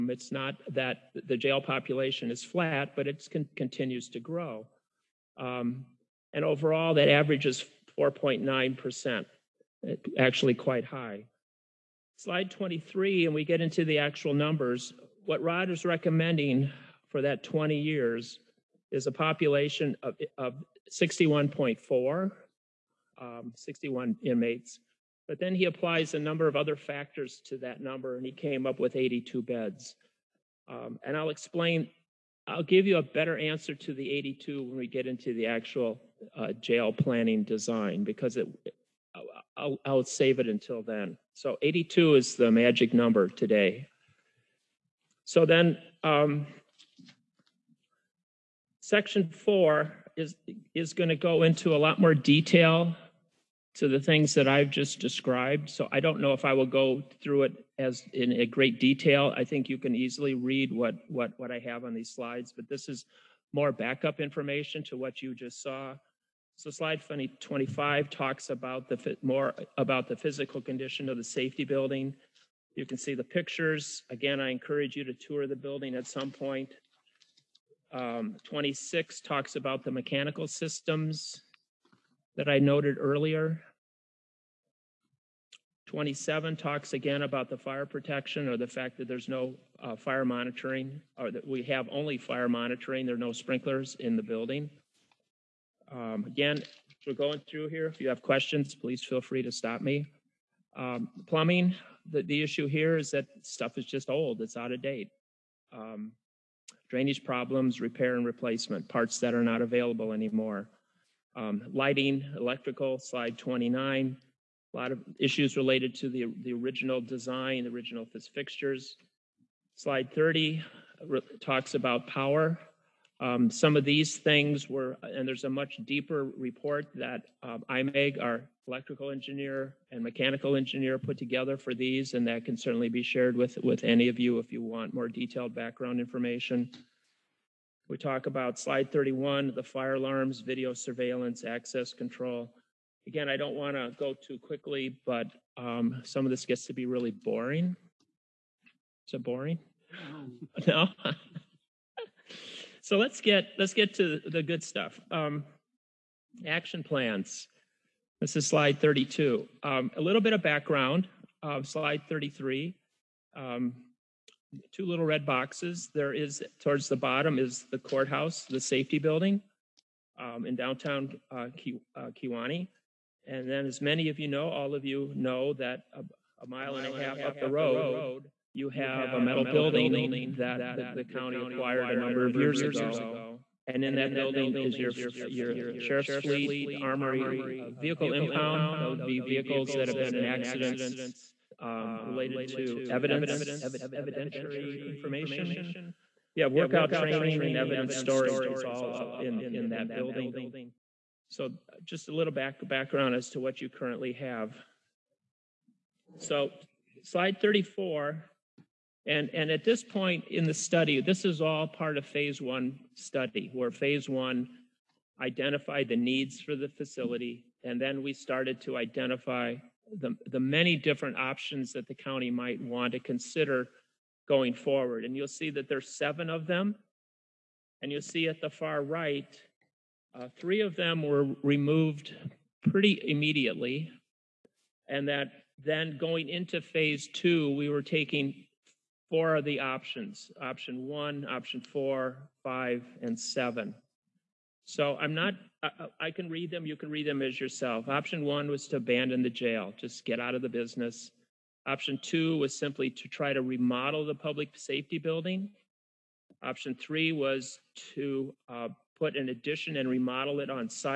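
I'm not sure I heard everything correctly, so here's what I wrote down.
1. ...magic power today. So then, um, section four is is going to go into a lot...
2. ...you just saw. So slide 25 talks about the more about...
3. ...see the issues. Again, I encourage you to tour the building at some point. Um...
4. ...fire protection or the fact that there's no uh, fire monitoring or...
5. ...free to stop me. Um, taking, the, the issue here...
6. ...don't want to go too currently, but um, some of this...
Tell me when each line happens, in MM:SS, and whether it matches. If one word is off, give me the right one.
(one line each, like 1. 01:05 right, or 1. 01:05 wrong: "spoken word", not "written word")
1. 00:42 wrong: "number", not "power"
2. 01:05 right
3. 01:12 wrong: "pictures", not "issues"
4. 01:27 right
5. 01:39 wrong: "plumbing", not "taking"
6. 02:23 wrong: "quickly", not "currently".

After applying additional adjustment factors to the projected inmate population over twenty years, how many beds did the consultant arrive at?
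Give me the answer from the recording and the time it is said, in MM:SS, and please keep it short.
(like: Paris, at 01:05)
82, at 00:28.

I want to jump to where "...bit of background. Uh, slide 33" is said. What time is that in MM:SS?
02:40.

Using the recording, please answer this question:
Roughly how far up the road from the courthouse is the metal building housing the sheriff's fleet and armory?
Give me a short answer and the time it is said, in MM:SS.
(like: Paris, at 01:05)
a mile and a half, at 02:56.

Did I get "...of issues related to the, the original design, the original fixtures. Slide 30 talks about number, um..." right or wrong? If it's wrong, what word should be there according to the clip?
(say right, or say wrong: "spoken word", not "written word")
wrong: "power", not "number".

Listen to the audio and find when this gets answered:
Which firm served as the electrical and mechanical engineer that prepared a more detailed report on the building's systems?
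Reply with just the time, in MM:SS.
02:07.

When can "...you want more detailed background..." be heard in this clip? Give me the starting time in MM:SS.
02:14.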